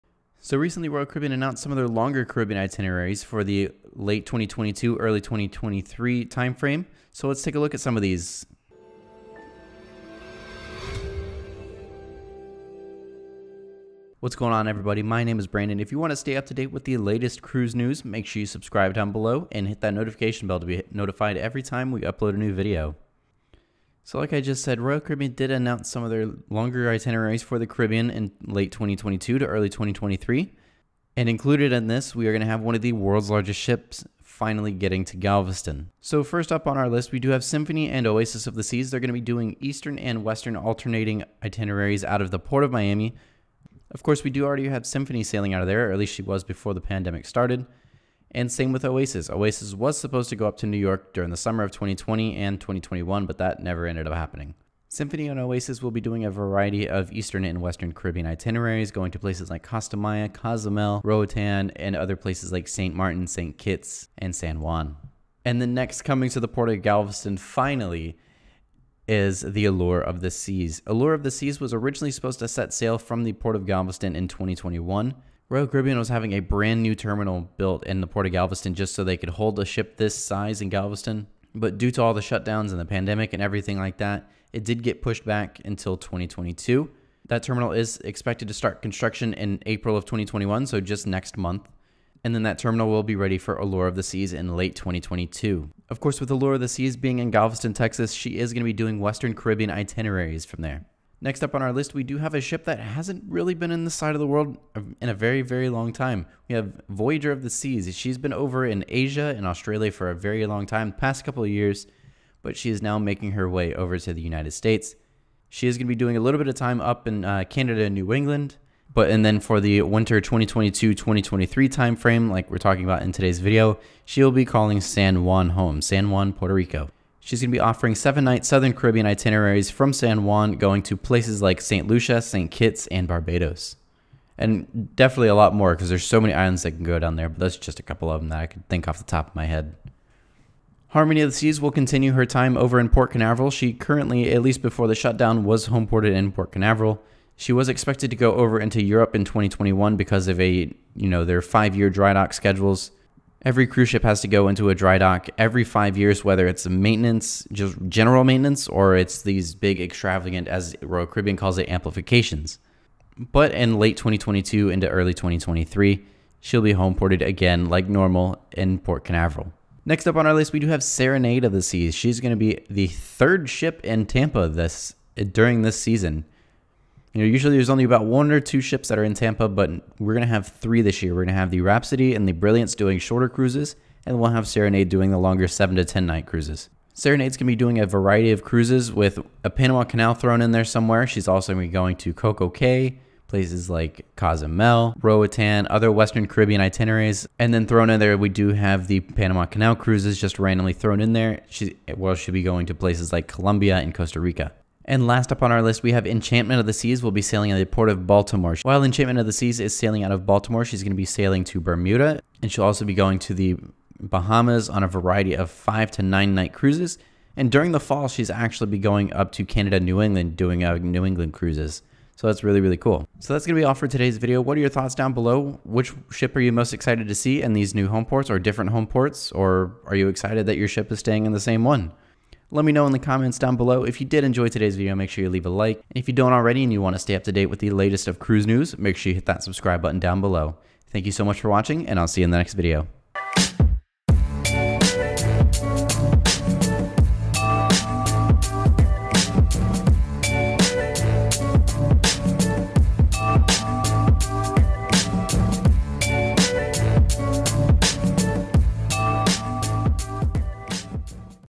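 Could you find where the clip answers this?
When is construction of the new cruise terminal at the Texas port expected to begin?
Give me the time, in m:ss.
1:29.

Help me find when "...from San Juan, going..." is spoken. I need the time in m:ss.
2:09.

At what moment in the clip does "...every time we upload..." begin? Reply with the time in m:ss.
0:21.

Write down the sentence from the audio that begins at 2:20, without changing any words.
Harmony of the Seas will continue her time over in Port Canaveral.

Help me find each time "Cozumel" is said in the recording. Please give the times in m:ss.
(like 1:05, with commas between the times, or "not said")
1:00, 3:14.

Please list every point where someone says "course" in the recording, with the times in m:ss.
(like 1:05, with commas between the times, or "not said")
0:44, 1:35.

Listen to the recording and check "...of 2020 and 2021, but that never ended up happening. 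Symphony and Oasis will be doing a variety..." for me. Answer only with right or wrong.
right.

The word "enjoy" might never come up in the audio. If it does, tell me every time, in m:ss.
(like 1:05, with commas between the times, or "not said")
3:54.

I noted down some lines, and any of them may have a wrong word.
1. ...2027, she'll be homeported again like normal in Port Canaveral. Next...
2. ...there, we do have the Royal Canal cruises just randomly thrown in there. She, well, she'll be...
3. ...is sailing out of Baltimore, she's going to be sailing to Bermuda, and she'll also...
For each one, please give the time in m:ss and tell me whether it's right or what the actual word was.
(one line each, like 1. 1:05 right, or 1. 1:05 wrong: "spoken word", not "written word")
1. 2:45 wrong: "2023", not "2027"
2. 3:17 wrong: "Panama", not "Royal"
3. 3:29 right.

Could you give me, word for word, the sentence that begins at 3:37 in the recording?
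And during the fall, she's actually be going up to Canada, New England, doing uh, New England cruises.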